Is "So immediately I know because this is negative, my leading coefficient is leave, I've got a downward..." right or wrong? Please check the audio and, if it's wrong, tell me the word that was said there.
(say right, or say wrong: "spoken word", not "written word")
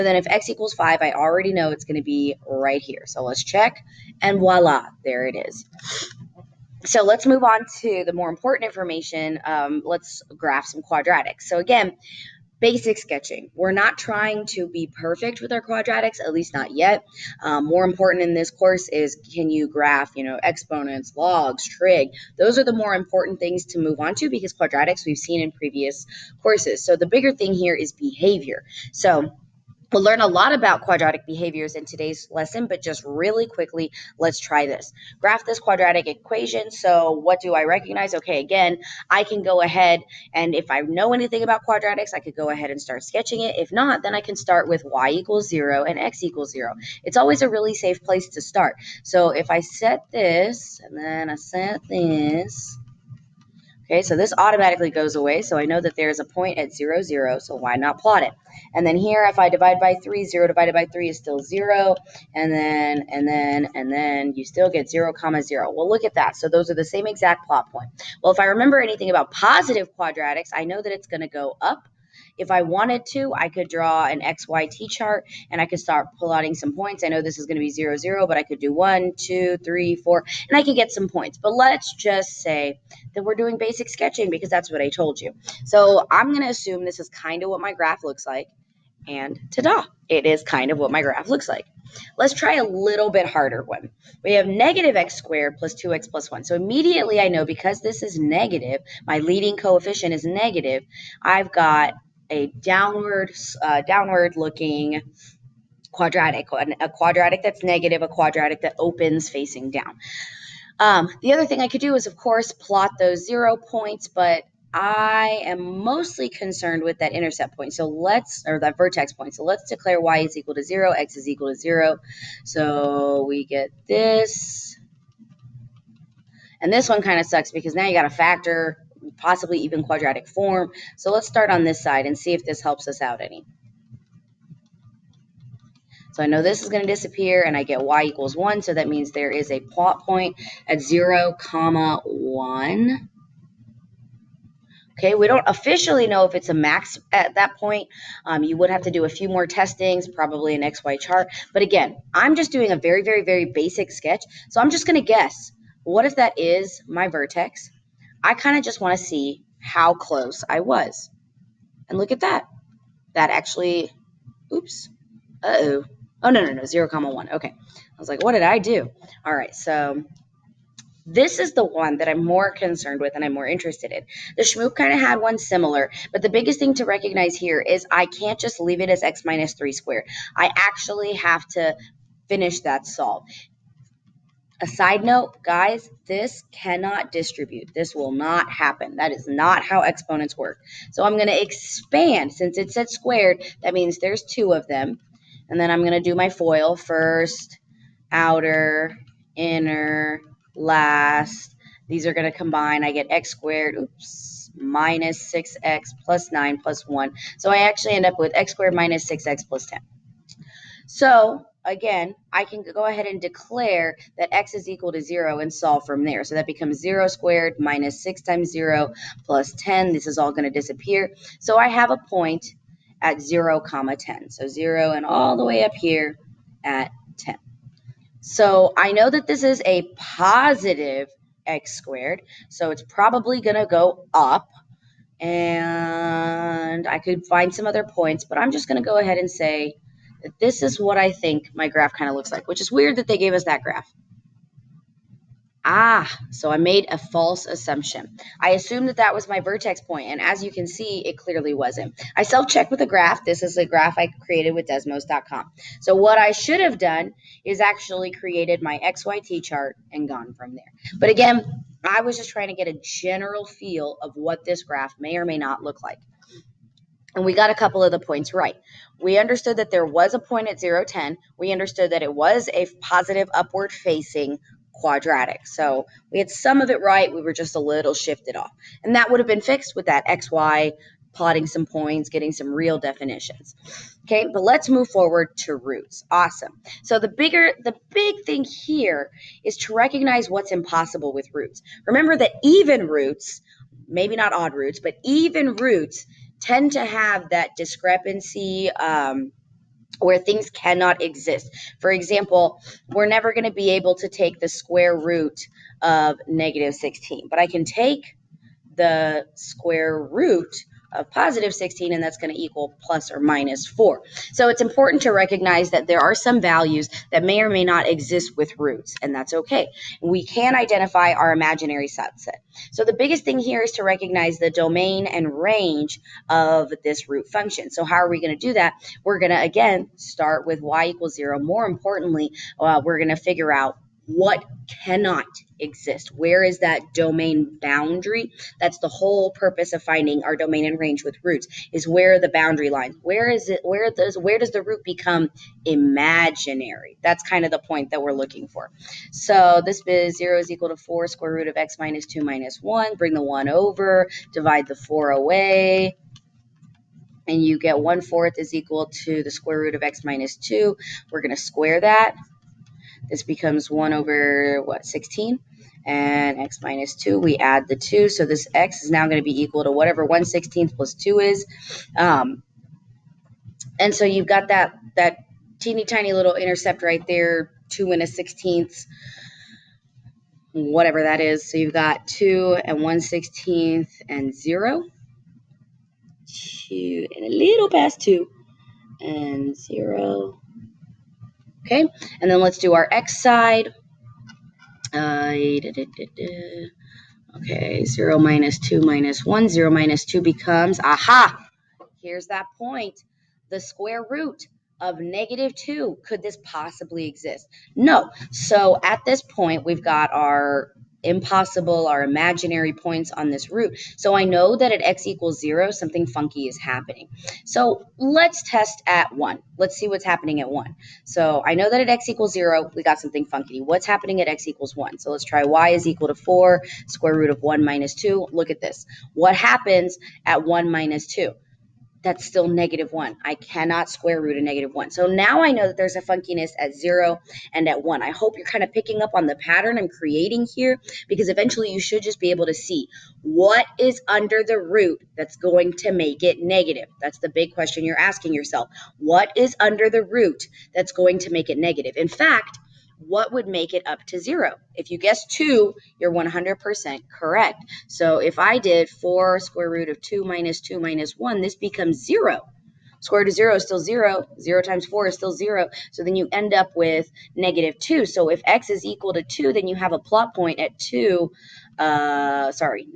wrong: "negative", not "leave".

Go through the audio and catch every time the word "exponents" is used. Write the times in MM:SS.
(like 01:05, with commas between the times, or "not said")
00:20, 03:09.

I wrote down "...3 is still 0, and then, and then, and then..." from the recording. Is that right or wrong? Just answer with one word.
right.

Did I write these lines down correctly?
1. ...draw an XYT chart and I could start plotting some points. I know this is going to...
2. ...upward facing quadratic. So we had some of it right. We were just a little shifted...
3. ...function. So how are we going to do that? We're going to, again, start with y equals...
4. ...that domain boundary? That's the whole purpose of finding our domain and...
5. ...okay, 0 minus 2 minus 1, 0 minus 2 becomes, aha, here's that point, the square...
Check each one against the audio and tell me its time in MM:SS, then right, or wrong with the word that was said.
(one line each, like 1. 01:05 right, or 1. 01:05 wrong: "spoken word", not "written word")
1. 01:13 right
2. 04:33 right
3. 05:27 right
4. 05:36 right
5. 06:37 right.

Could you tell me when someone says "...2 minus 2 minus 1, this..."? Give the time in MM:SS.
07:40.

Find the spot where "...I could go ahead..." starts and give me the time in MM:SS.
00:42.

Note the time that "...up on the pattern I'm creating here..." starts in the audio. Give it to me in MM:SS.
07:19.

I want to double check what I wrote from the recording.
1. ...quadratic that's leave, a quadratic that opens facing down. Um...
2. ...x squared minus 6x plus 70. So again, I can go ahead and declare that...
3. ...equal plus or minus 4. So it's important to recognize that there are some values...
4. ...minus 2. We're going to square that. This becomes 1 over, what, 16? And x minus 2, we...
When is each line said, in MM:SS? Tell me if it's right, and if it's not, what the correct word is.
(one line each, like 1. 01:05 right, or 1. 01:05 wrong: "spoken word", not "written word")
1. 01:46 wrong: "negative", not "leave"
2. 03:28 wrong: "10", not "70"
3. 05:12 right
4. 06:00 right.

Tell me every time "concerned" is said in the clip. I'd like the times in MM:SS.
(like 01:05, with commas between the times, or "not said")
01:56, 02:52.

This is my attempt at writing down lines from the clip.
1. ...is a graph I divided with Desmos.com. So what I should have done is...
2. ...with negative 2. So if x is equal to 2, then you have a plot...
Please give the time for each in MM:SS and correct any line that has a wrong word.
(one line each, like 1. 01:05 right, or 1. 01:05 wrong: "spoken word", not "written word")
1. 04:13 wrong: "created", not "divided"
2. 07:46 right.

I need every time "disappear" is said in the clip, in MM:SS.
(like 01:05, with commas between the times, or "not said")
02:16, 03:40.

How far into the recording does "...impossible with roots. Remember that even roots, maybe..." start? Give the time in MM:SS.
04:50.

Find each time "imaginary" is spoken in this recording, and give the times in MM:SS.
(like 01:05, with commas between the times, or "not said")
05:21, 05:45, 06:52.